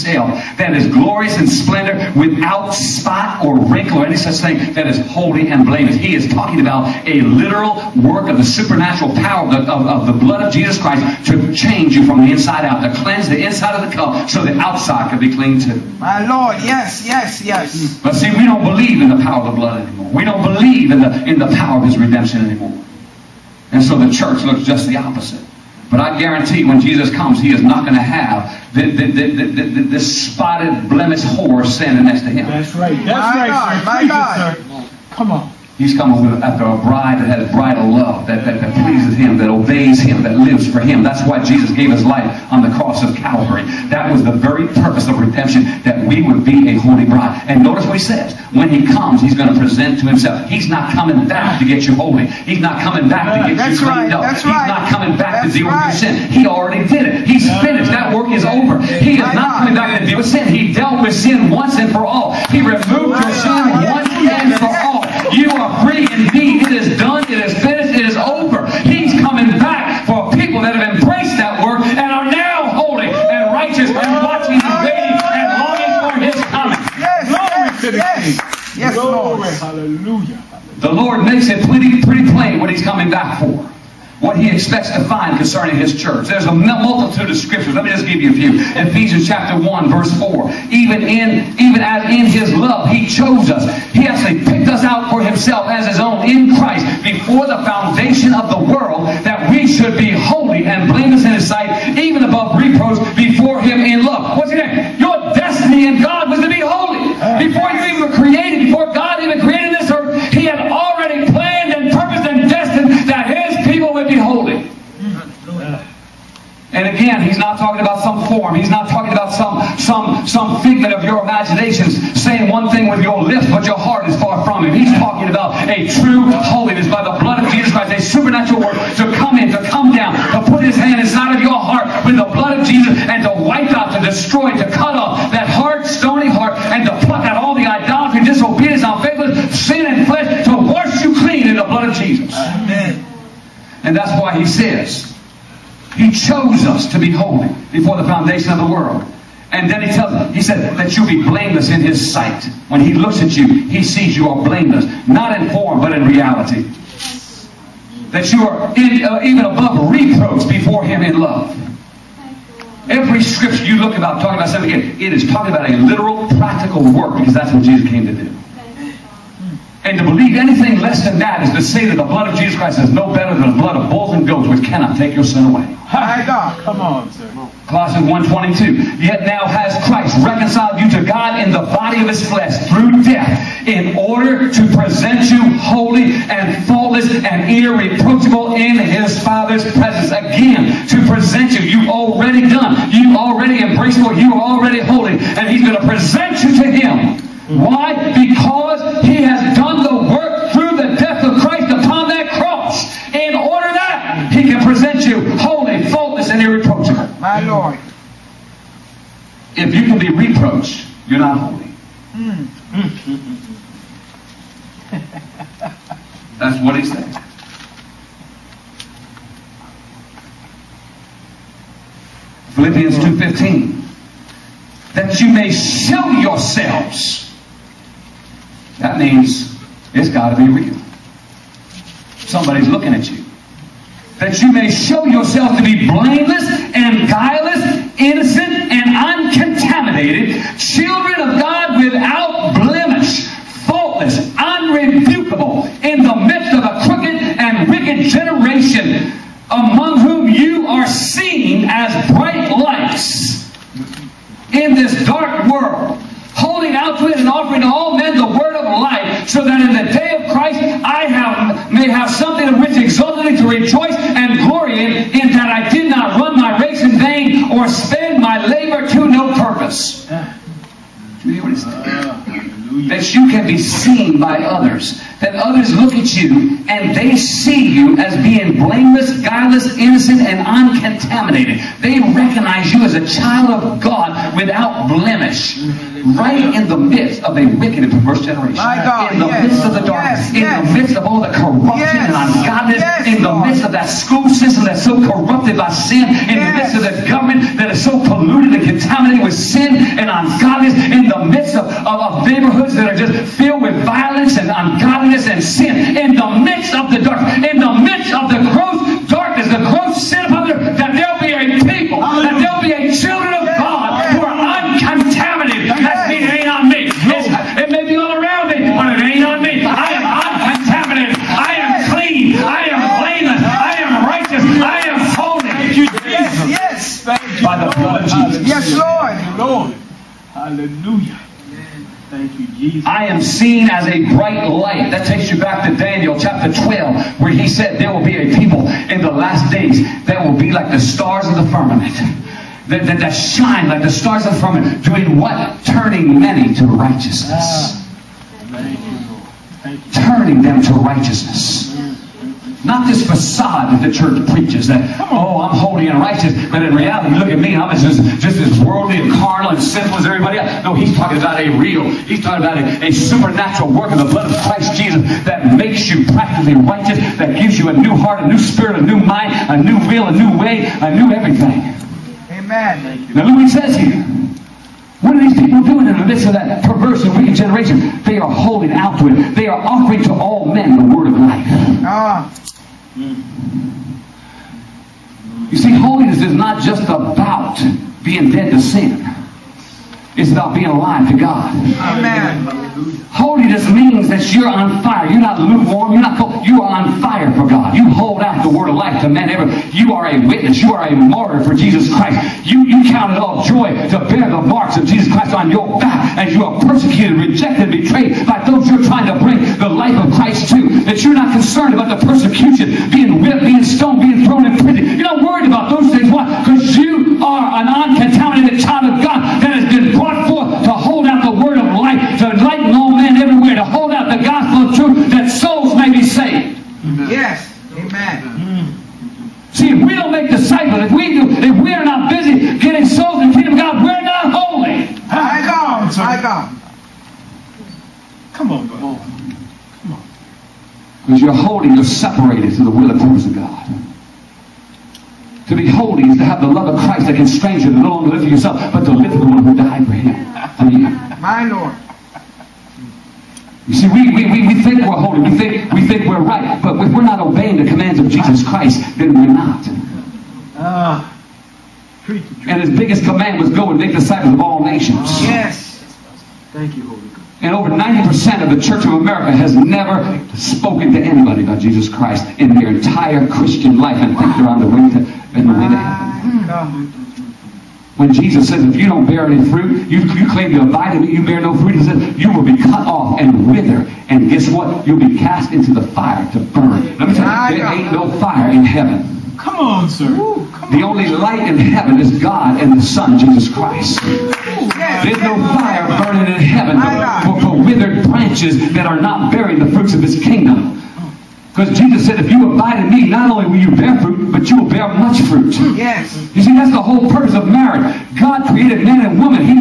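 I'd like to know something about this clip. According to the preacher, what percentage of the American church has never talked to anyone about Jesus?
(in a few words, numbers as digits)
over 90%.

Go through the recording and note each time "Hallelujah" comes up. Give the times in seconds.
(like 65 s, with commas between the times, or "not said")
79 s, 330 s, 392 s.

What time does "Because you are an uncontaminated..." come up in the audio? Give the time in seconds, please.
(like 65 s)
416 s.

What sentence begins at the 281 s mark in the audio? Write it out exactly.
They recognize you as a child of God without blemish.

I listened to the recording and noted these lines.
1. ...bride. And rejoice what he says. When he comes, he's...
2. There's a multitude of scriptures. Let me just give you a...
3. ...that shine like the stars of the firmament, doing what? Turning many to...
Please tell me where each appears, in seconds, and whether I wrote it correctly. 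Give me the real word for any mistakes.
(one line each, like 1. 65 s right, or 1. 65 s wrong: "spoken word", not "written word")
1. 47 s wrong: "notice", not "rejoice"
2. 86 s right
3. 342 s right.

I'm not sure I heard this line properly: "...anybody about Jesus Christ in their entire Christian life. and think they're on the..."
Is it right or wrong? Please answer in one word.
right.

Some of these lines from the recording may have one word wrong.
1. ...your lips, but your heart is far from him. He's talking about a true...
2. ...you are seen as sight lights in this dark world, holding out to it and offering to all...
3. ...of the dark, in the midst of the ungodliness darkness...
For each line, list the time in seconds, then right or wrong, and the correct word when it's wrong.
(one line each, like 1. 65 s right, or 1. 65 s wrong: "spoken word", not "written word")
1. 123 s right
2. 250 s wrong: "bright", not "sight"
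3. 306 s wrong: "gross", not "ungodliness".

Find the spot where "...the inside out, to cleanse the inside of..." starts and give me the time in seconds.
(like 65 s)
12 s.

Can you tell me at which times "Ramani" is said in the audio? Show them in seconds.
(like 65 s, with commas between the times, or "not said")
not said.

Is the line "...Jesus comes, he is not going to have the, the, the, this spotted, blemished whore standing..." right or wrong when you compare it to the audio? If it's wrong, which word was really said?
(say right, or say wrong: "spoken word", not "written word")
right.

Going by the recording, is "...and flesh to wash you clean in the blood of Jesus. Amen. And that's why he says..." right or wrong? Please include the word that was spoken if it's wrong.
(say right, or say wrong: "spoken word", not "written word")
right.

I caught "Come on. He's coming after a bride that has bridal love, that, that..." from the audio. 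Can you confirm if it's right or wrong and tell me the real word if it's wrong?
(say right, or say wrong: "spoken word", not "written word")
right.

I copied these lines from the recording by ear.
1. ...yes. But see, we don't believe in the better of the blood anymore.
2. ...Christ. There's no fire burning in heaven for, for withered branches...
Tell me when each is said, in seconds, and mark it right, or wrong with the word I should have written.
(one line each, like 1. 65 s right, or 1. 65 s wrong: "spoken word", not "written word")
1. 17 s wrong: "power", not "better"
2. 493 s right.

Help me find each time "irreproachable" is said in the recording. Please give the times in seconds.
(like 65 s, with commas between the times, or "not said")
187 s, 206 s.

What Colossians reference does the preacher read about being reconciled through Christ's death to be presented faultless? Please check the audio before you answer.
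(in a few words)
Colossians 1:22.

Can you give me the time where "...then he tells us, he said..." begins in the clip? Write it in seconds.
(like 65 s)
149 s.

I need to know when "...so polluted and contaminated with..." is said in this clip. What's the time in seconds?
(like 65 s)
297 s.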